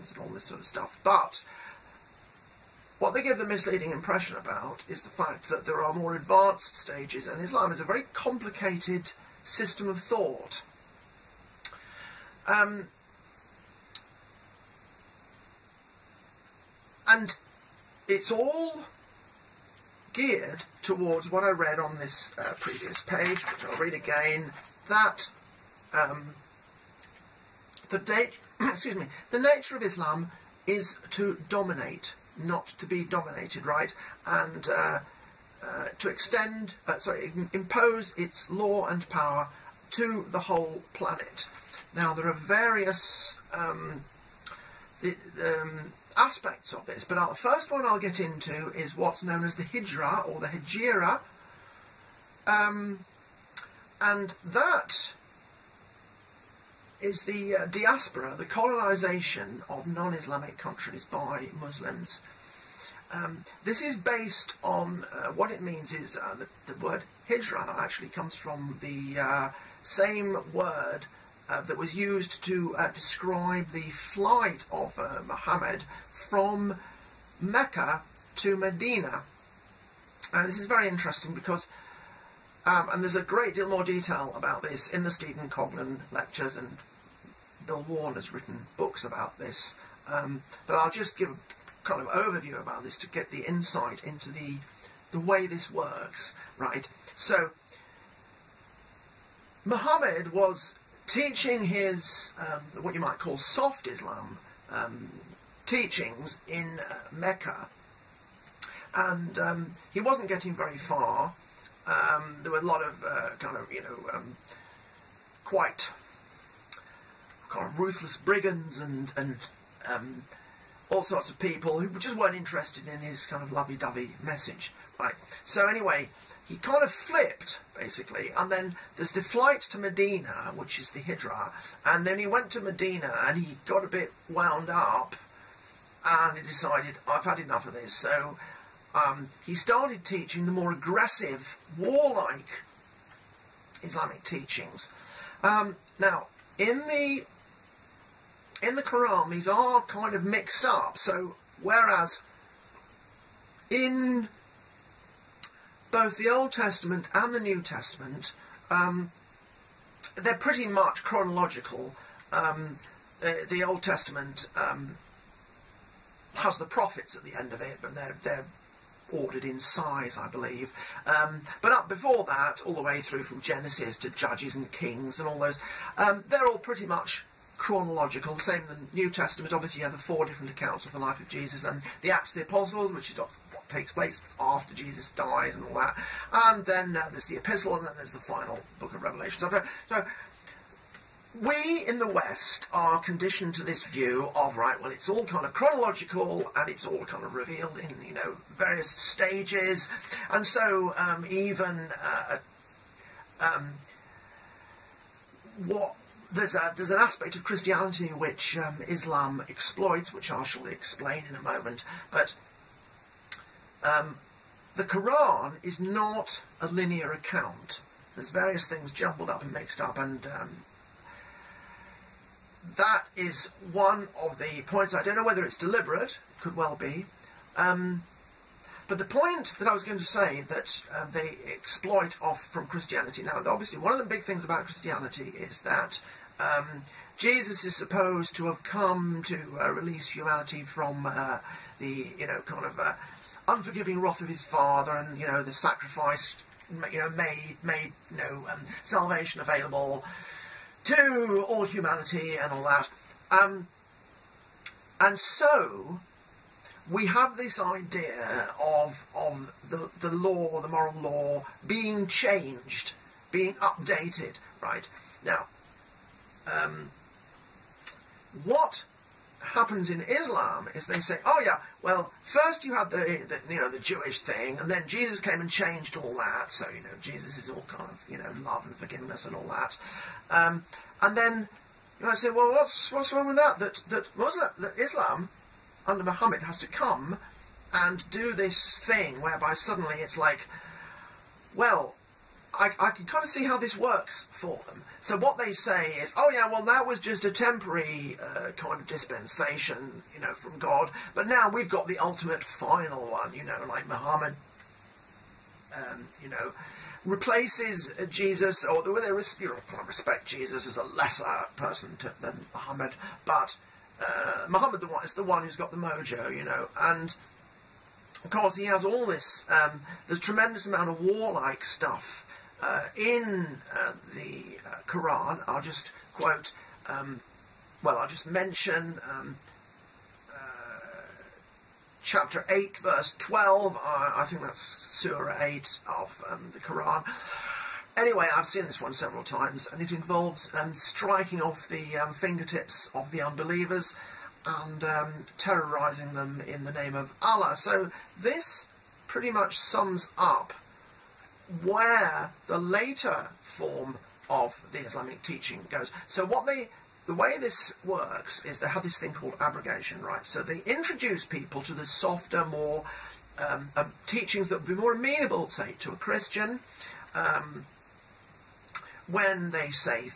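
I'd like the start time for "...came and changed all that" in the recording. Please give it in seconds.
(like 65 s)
275 s.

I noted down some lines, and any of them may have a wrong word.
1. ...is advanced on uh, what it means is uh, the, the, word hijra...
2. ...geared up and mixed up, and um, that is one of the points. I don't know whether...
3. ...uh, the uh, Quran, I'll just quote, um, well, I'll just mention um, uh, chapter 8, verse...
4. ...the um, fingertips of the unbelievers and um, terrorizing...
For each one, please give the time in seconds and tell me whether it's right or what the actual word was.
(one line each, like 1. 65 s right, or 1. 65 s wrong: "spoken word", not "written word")
1. 63 s wrong: "based", not "advanced"
2. 218 s wrong: "jumbled", not "geared"
3. 323 s right
4. 341 s right.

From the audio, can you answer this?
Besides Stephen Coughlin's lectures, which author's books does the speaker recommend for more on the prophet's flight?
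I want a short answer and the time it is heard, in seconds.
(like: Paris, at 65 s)
Bill Warner, at 87 s.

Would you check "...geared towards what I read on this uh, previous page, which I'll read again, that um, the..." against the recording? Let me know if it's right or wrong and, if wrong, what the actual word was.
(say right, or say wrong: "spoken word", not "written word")
right.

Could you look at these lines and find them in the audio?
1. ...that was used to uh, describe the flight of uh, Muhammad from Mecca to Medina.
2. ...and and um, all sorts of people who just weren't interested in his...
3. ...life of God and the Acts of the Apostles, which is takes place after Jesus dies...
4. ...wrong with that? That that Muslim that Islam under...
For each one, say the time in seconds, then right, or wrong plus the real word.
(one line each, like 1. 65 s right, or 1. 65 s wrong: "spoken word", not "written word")
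1. 71 s right
2. 118 s right
3. 180 s wrong: "Jesus", not "God"
4. 283 s right.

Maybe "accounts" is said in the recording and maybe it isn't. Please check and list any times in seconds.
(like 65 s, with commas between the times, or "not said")
180 s, 217 s.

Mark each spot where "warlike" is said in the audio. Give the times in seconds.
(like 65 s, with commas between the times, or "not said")
141 s, 321 s.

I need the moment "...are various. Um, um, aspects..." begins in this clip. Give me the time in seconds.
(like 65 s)
42 s.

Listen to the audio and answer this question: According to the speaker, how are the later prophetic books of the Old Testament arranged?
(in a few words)
Ordered in size.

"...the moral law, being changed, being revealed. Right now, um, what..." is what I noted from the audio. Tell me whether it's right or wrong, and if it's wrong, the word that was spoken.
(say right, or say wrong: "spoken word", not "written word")
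wrong: "updated", not "revealed".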